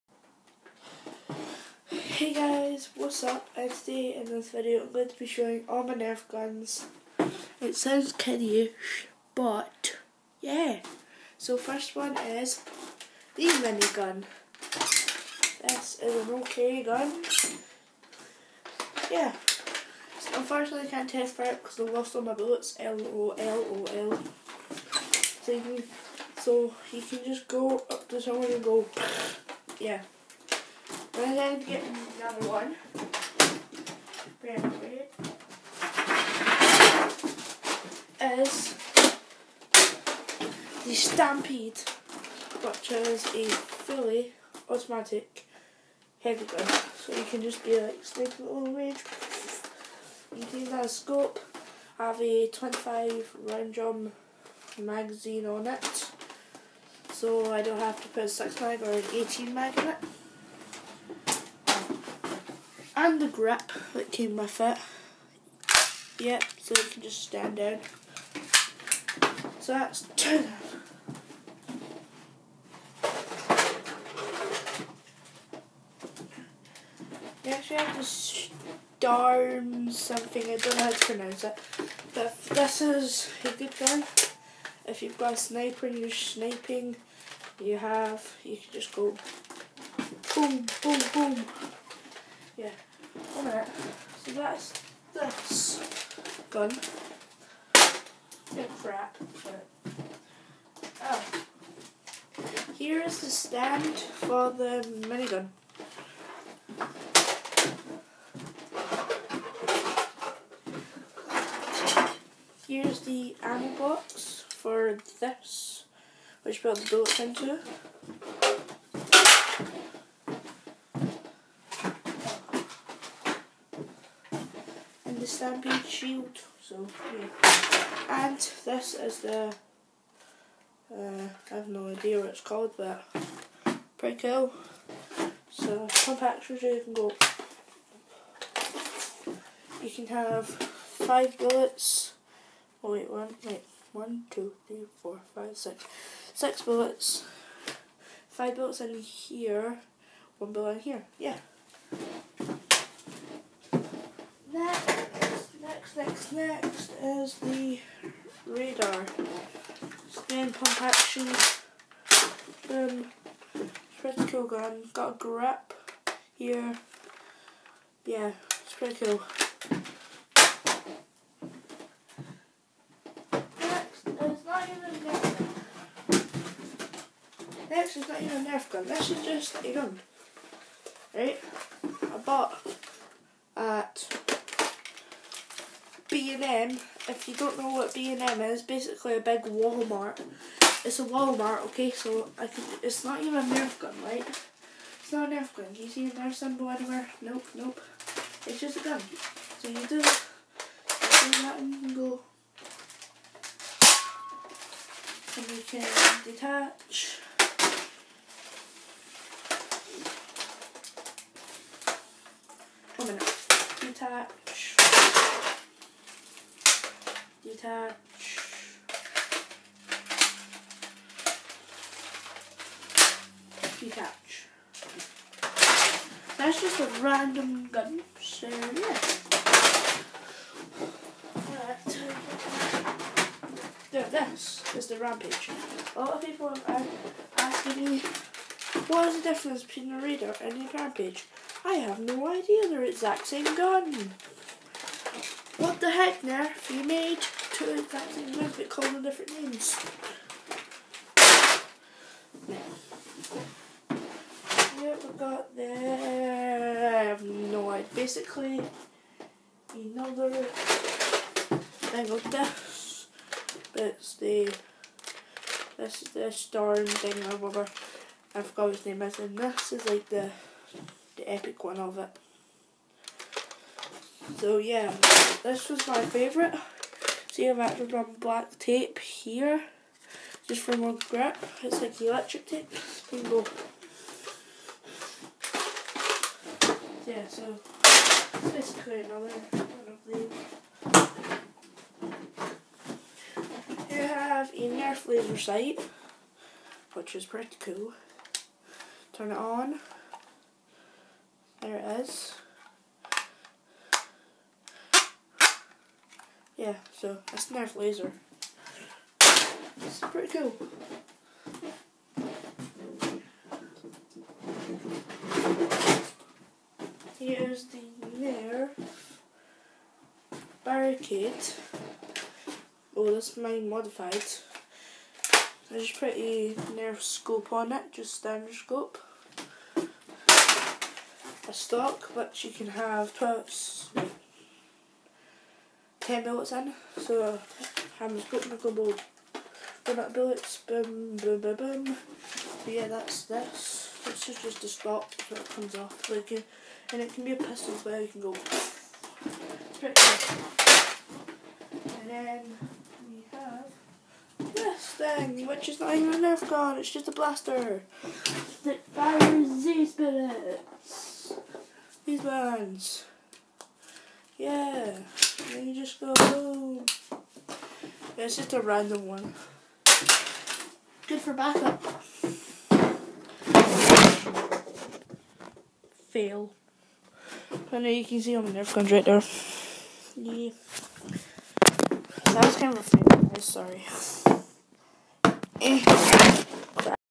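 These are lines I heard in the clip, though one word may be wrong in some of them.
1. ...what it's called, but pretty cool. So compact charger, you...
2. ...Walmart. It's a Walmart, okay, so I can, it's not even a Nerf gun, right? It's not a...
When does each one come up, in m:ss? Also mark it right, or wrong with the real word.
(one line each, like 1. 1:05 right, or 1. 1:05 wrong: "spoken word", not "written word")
1. 2:12 right
2. 3:09 right.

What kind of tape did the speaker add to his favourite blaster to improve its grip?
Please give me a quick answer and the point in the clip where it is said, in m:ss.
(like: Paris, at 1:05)
black tape, at 4:38.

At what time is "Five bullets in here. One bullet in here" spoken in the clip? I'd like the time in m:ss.
2:28.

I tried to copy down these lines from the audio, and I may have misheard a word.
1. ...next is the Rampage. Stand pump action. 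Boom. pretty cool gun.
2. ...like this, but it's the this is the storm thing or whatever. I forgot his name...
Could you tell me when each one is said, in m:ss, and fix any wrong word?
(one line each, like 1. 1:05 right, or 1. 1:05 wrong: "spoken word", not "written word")
1. 2:36 wrong: "Raider", not "Rampage"
2. 4:22 right.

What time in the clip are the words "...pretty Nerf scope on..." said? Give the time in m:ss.
5:25.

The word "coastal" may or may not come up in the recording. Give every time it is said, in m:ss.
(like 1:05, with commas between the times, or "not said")
not said.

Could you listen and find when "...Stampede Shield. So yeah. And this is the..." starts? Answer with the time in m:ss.
2:05.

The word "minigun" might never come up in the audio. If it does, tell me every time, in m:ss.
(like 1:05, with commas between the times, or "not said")
0:13, 1:45.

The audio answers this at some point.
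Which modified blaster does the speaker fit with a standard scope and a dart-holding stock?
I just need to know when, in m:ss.
5:18.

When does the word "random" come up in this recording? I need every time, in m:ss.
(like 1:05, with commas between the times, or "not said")
3:47, 6:08.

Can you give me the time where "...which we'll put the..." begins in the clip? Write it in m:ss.
1:56.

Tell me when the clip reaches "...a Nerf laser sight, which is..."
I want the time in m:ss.
4:54.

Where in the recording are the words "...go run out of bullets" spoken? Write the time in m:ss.
5:38.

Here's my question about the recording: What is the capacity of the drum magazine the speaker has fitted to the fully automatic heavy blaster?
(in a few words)
25 rounds.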